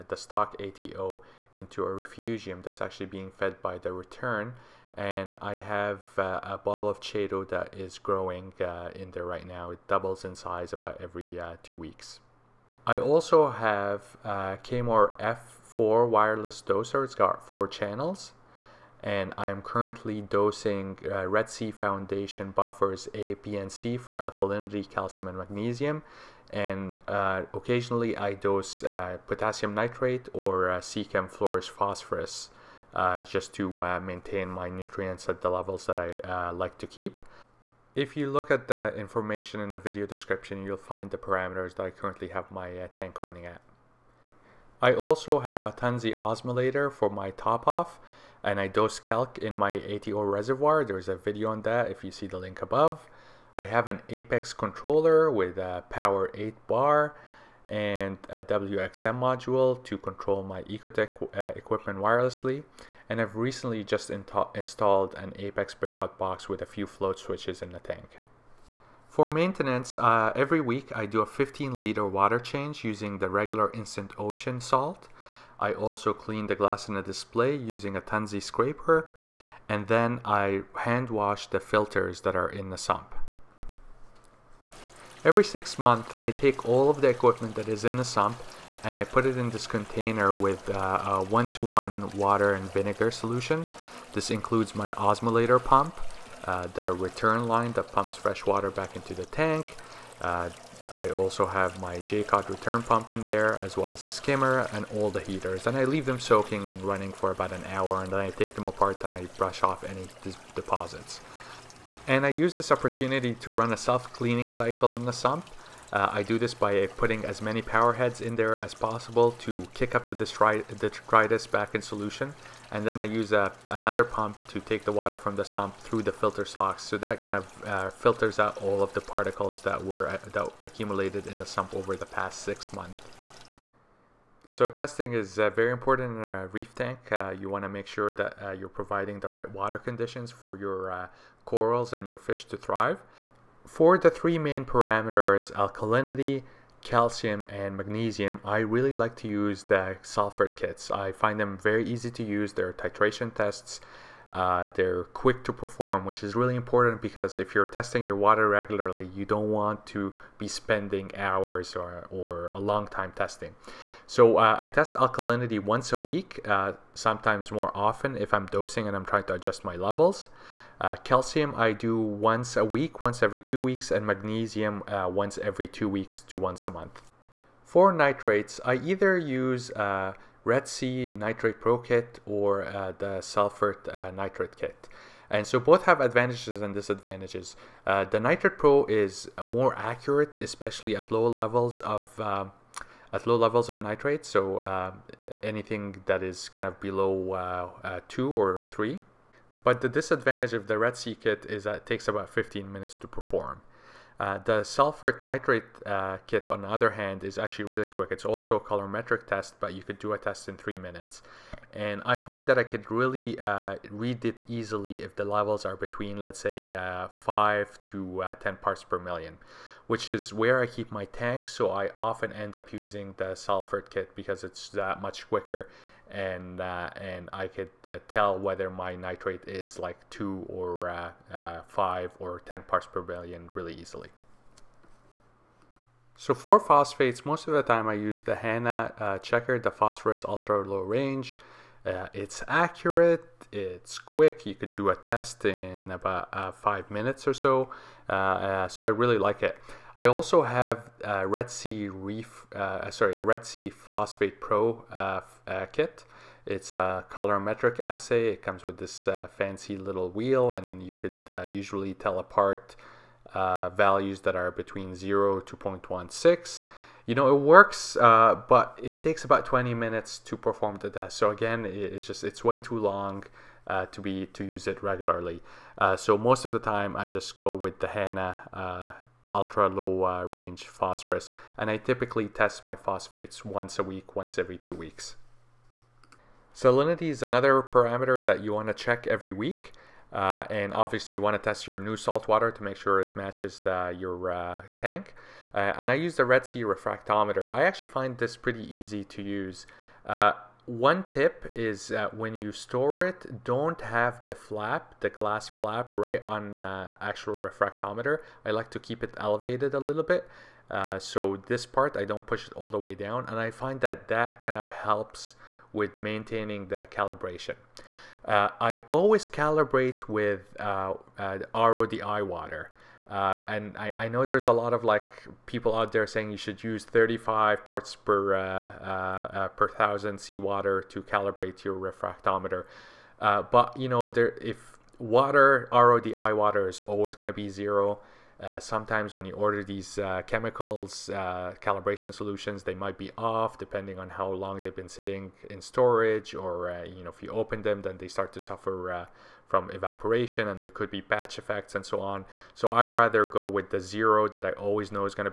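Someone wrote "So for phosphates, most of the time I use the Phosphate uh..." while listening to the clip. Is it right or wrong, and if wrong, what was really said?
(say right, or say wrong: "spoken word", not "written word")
wrong: "Hanna", not "Phosphate".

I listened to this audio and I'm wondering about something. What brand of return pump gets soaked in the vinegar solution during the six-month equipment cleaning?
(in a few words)
Jecod.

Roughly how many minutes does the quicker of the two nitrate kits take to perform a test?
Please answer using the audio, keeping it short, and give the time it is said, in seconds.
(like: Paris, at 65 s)
3 minutes, at 210 s.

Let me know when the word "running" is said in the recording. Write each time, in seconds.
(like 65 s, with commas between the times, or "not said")
43 s, 106 s.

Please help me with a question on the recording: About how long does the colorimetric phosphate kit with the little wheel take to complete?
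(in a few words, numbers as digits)
20 minutes.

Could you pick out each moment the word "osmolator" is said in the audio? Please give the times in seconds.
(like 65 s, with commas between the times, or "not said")
46 s, 94 s.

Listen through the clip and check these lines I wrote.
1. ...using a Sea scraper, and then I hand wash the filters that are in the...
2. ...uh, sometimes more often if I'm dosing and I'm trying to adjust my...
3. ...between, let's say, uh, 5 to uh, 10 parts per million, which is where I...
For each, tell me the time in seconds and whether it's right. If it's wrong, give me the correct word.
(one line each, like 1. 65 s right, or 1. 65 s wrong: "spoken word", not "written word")
1. 77 s wrong: "Tunze", not "Sea"
2. 166 s right
3. 215 s right.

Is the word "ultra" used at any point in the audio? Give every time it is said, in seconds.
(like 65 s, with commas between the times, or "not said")
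240 s, 279 s.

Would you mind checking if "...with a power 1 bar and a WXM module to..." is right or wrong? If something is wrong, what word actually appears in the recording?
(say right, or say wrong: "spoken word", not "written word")
wrong: "8", not "1".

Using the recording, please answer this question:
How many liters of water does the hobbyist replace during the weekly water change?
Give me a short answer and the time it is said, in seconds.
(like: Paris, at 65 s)
15 liters, at 71 s.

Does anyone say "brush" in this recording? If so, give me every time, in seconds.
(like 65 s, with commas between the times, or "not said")
109 s.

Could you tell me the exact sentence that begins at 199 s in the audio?
But the disadvantage of the Red Sea kit is that it takes about 15 minutes to perform.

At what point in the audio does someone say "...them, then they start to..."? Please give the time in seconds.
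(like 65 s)
347 s.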